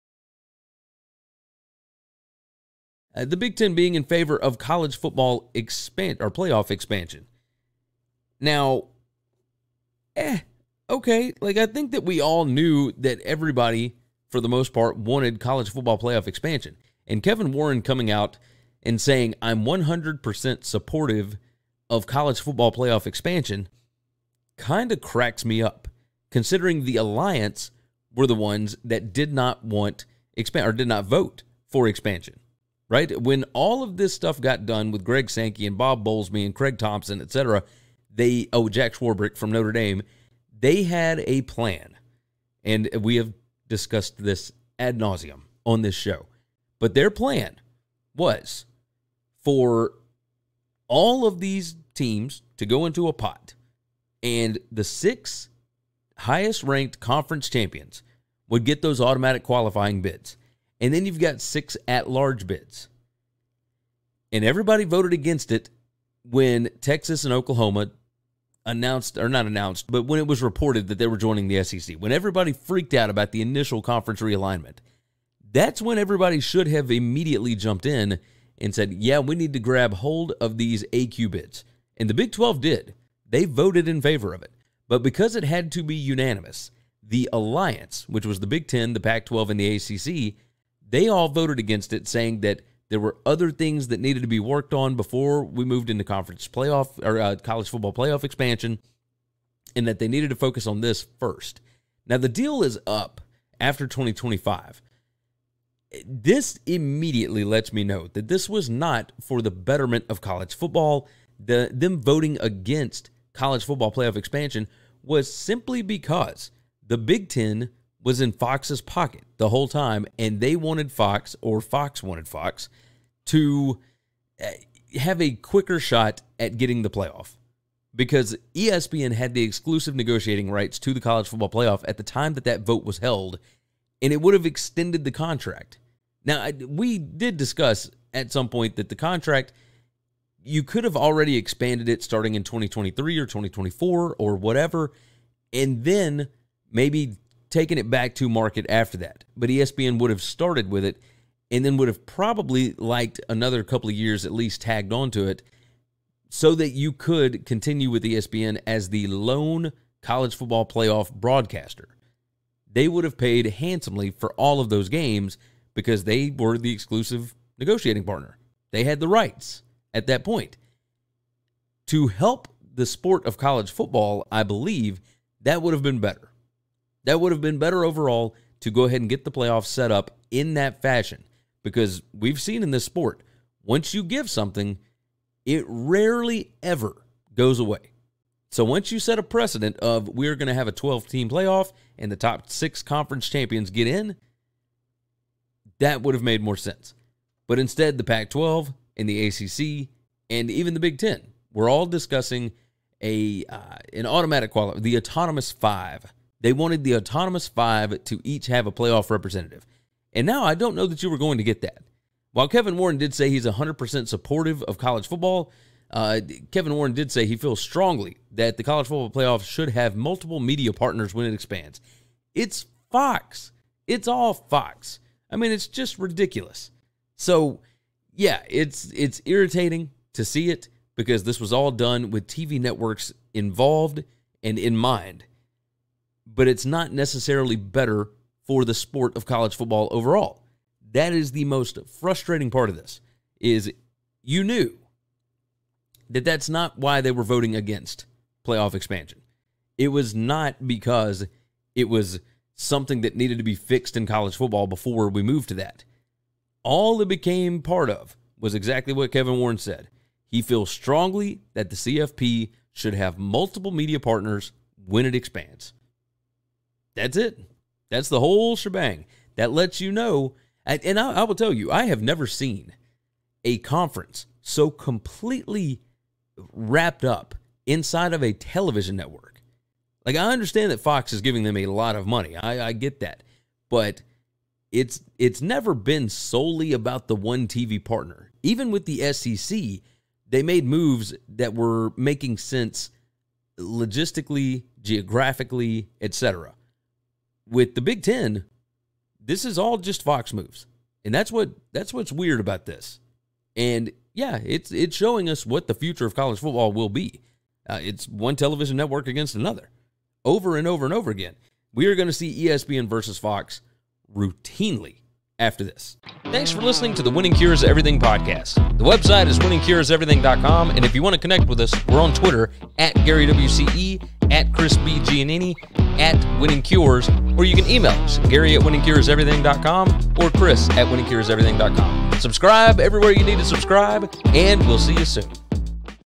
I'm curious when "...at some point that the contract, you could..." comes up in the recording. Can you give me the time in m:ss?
2:18.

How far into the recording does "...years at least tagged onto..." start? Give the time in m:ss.
2:33.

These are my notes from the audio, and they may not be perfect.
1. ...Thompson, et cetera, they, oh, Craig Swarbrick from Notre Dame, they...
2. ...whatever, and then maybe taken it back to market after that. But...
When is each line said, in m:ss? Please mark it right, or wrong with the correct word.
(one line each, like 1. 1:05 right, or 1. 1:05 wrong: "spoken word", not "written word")
1. 0:36 wrong: "Jack", not "Craig"
2. 2:24 right.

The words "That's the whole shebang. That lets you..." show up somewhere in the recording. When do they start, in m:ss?
4:27.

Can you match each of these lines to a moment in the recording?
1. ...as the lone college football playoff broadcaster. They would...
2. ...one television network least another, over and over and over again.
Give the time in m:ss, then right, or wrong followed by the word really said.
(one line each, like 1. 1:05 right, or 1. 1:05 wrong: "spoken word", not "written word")
1. 2:38 right
2. 5:08 wrong: "against", not "least".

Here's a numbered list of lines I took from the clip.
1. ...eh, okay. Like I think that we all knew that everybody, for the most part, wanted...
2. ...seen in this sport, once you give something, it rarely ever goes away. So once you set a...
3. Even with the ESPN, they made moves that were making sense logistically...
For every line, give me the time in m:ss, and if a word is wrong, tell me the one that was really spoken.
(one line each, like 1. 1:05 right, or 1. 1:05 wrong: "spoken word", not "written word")
1. 0:10 right
2. 3:02 right
3. 4:48 wrong: "SEC", not "ESPN".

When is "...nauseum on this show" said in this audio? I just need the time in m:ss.
0:44.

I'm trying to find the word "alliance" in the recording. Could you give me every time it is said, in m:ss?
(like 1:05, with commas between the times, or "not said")
0:26, 1:27.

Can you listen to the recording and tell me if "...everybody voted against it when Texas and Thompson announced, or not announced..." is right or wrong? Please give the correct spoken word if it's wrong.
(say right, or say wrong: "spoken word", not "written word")
wrong: "Oklahoma", not "Thompson".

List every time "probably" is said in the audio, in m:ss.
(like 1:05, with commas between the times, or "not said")
2:32.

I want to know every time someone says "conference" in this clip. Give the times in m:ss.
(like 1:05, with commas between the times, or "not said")
0:56, 1:13, 1:36, 3:12, 4:33.